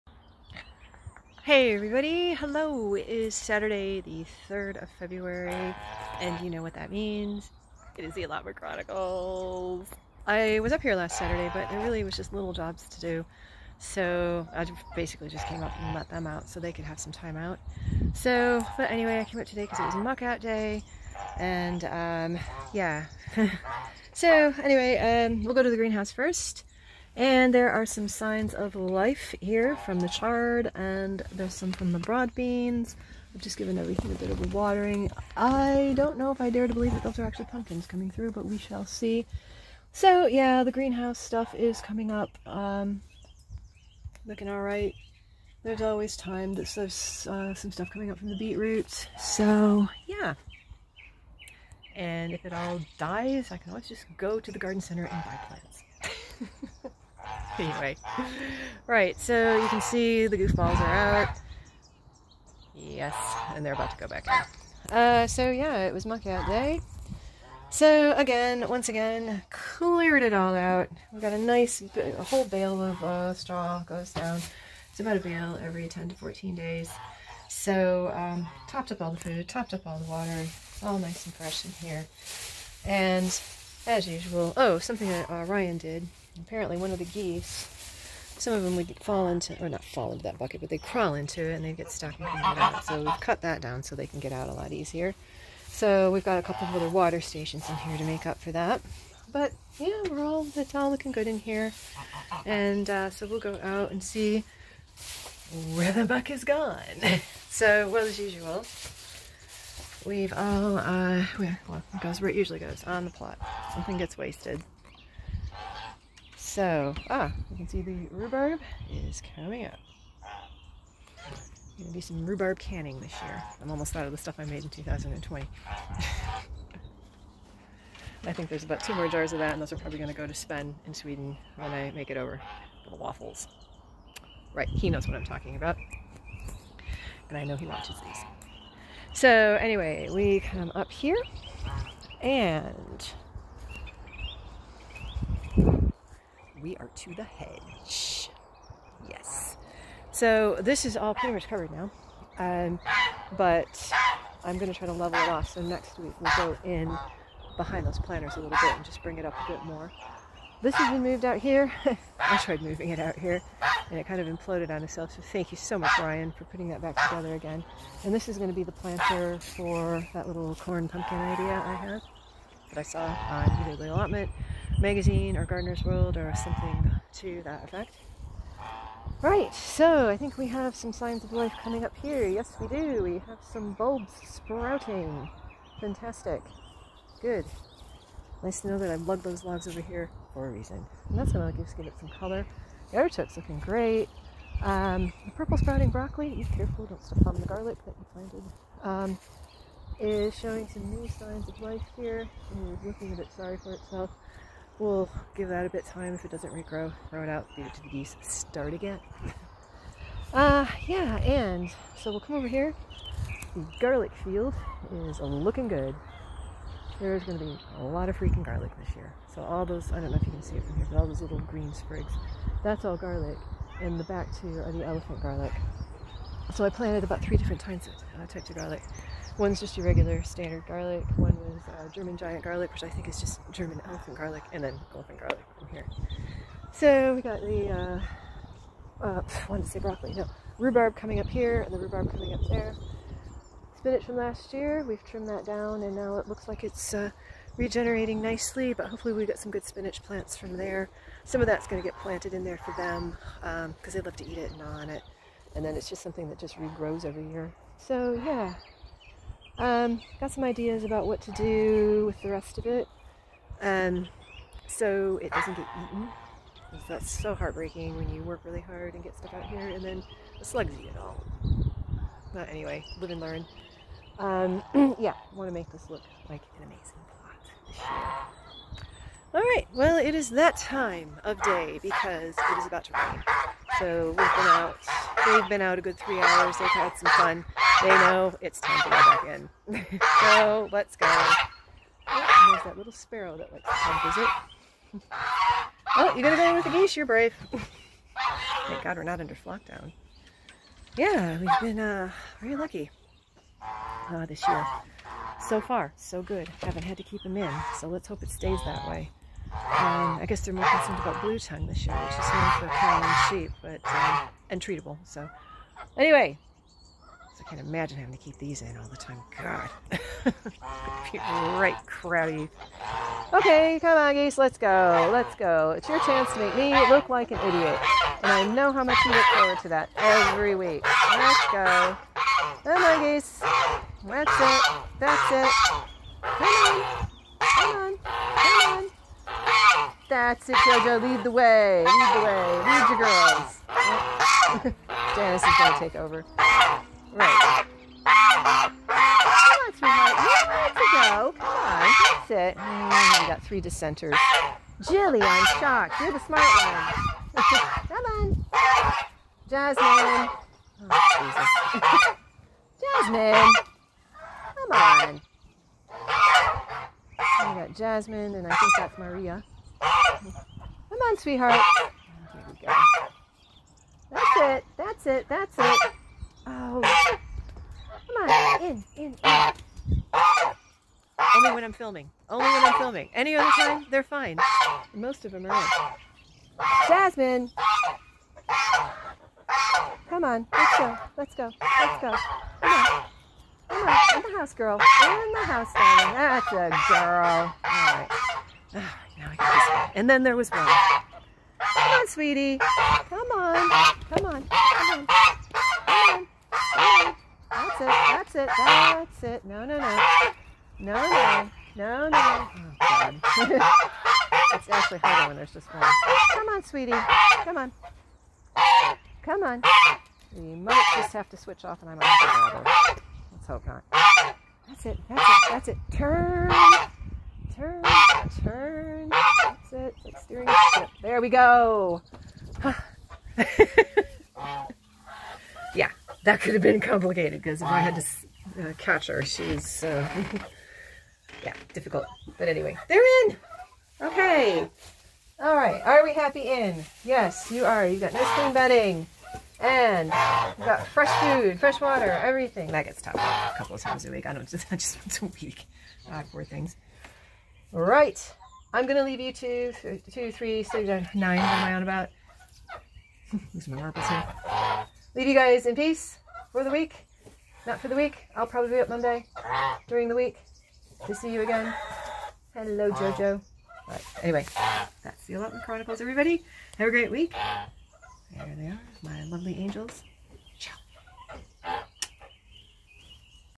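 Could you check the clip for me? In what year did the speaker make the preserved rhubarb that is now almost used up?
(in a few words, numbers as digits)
2020.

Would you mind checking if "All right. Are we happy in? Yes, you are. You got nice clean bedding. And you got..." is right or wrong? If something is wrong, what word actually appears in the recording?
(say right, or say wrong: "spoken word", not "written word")
right.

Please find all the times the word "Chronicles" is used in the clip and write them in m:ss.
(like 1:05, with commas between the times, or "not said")
0:08, 7:55.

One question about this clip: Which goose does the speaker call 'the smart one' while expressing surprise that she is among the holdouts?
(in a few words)
Jilly.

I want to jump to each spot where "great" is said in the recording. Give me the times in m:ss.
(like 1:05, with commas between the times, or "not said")
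3:13, 7:56.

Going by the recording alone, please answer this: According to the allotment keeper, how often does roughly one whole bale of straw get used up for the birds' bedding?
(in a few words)
10 to 14 days.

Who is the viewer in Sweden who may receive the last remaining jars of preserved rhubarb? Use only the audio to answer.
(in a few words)
Sven.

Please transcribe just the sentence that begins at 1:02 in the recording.
Yes, and they're about to go back in.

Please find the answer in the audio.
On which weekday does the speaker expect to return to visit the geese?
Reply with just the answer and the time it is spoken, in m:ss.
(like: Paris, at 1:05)
Monday, at 7:48.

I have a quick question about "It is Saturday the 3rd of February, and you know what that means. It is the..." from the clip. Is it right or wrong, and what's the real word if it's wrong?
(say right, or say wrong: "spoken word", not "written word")
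right.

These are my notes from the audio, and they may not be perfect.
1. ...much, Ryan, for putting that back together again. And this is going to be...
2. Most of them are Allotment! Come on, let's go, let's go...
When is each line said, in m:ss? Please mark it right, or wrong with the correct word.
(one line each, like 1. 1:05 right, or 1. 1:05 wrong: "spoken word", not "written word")
1. 2:45 right
2. 6:24 wrong: "Jasmine", not "Allotment".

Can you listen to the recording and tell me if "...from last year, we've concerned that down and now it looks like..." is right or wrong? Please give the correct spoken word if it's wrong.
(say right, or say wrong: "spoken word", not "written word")
wrong: "trimmed", not "concerned".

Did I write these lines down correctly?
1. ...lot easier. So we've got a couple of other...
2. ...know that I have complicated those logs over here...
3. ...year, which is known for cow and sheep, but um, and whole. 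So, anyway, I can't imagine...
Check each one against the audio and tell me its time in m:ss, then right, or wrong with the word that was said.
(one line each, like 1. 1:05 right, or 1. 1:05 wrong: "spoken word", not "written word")
1. 1:34 right
2. 3:08 wrong: "lugged", not "complicated"
3. 5:11 wrong: "treatable", not "whole".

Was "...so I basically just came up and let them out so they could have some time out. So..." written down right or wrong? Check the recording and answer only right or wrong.
right.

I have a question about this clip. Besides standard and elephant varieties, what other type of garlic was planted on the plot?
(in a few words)
German giant garlic.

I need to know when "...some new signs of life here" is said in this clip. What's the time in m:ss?
3:20.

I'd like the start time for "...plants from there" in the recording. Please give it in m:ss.
4:10.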